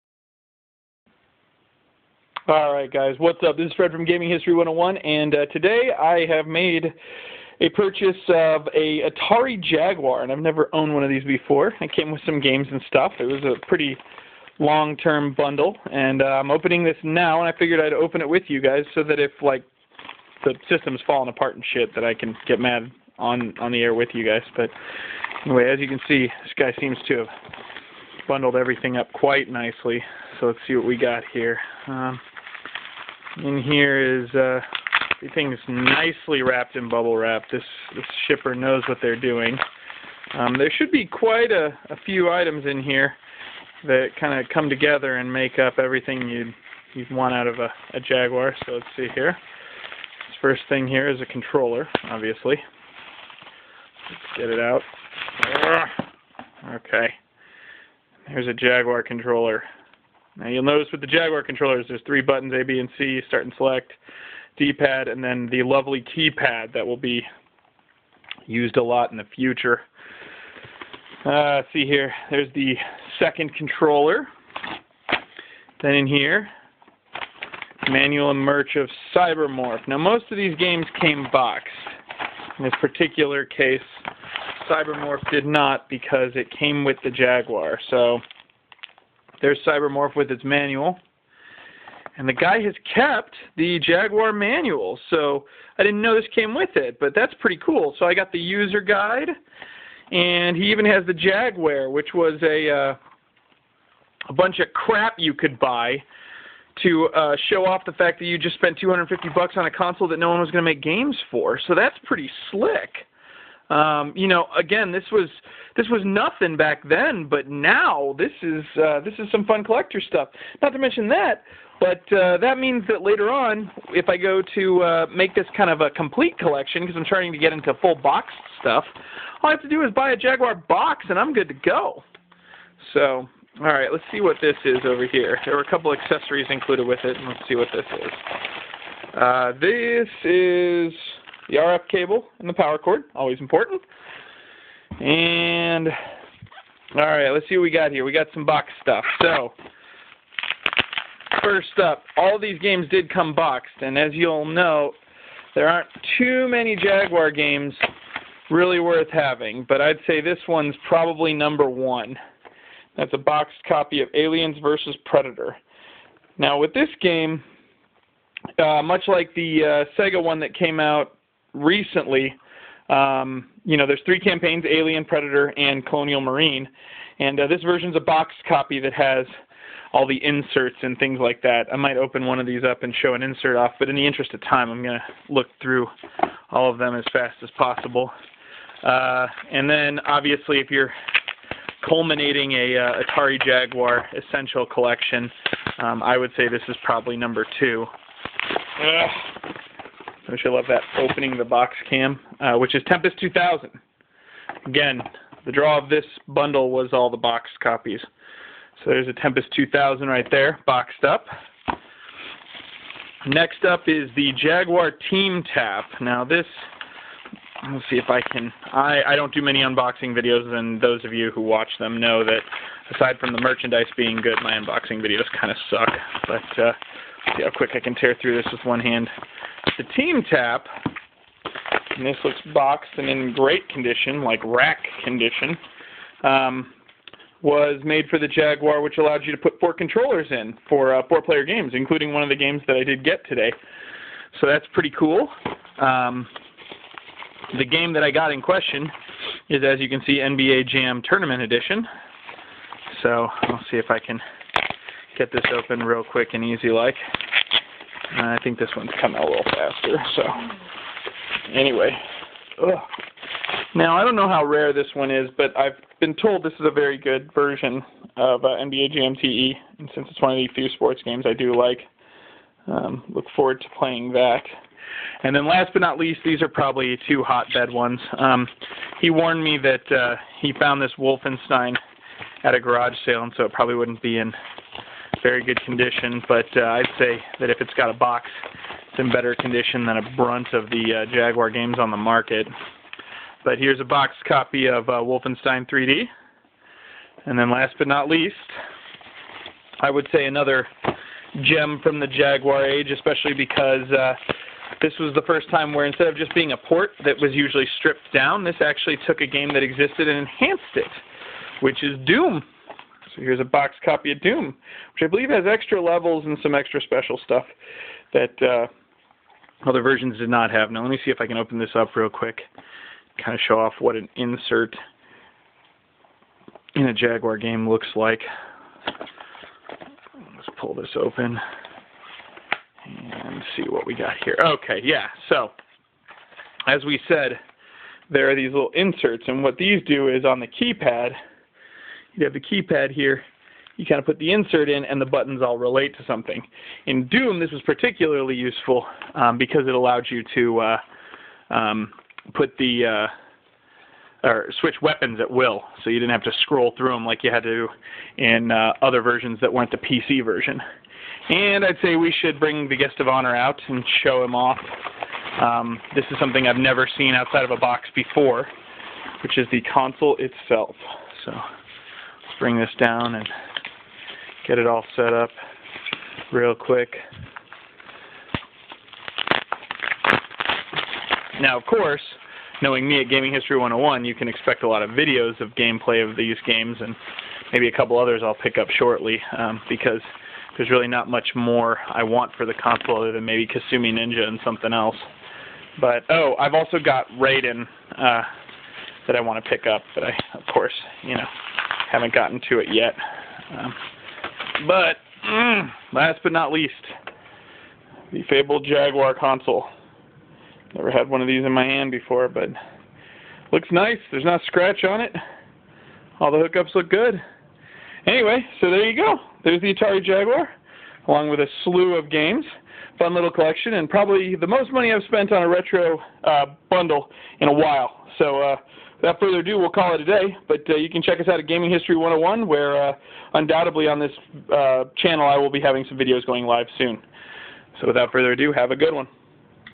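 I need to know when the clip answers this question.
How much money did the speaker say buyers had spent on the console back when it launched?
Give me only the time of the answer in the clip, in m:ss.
1:48.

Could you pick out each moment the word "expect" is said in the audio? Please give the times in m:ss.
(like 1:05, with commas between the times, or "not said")
6:24.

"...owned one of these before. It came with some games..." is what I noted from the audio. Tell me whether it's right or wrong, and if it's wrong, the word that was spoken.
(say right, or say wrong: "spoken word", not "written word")
right.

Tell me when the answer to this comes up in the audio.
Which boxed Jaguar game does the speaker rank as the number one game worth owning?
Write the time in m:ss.
2:44.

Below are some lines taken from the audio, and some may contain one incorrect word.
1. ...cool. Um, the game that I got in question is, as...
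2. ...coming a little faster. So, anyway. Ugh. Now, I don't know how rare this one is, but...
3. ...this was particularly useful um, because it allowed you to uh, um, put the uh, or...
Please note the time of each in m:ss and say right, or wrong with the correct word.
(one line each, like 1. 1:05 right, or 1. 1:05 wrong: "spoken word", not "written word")
1. 4:04 right
2. 4:18 right
3. 5:47 right.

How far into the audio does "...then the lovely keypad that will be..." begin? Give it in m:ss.
1:05.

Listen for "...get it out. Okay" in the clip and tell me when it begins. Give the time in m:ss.
0:54.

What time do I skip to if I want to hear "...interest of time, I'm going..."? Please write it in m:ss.
3:04.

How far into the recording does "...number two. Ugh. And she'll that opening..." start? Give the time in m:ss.
3:17.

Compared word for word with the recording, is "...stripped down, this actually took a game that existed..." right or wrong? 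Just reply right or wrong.
right.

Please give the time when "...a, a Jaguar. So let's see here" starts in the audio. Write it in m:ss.
0:47.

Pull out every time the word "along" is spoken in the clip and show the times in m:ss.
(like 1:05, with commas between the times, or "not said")
7:01.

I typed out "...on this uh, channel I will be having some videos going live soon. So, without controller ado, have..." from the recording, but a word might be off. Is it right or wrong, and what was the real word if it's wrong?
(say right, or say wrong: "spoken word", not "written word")
wrong: "further", not "controller".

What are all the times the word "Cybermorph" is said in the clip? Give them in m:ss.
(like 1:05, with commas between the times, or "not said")
1:19, 1:24, 1:29.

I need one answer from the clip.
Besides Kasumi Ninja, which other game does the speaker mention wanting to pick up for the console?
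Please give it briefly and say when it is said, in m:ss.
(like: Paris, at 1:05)
Raiden, at 6:37.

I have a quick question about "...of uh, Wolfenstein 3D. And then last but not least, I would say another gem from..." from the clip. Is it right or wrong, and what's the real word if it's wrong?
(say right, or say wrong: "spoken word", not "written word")
right.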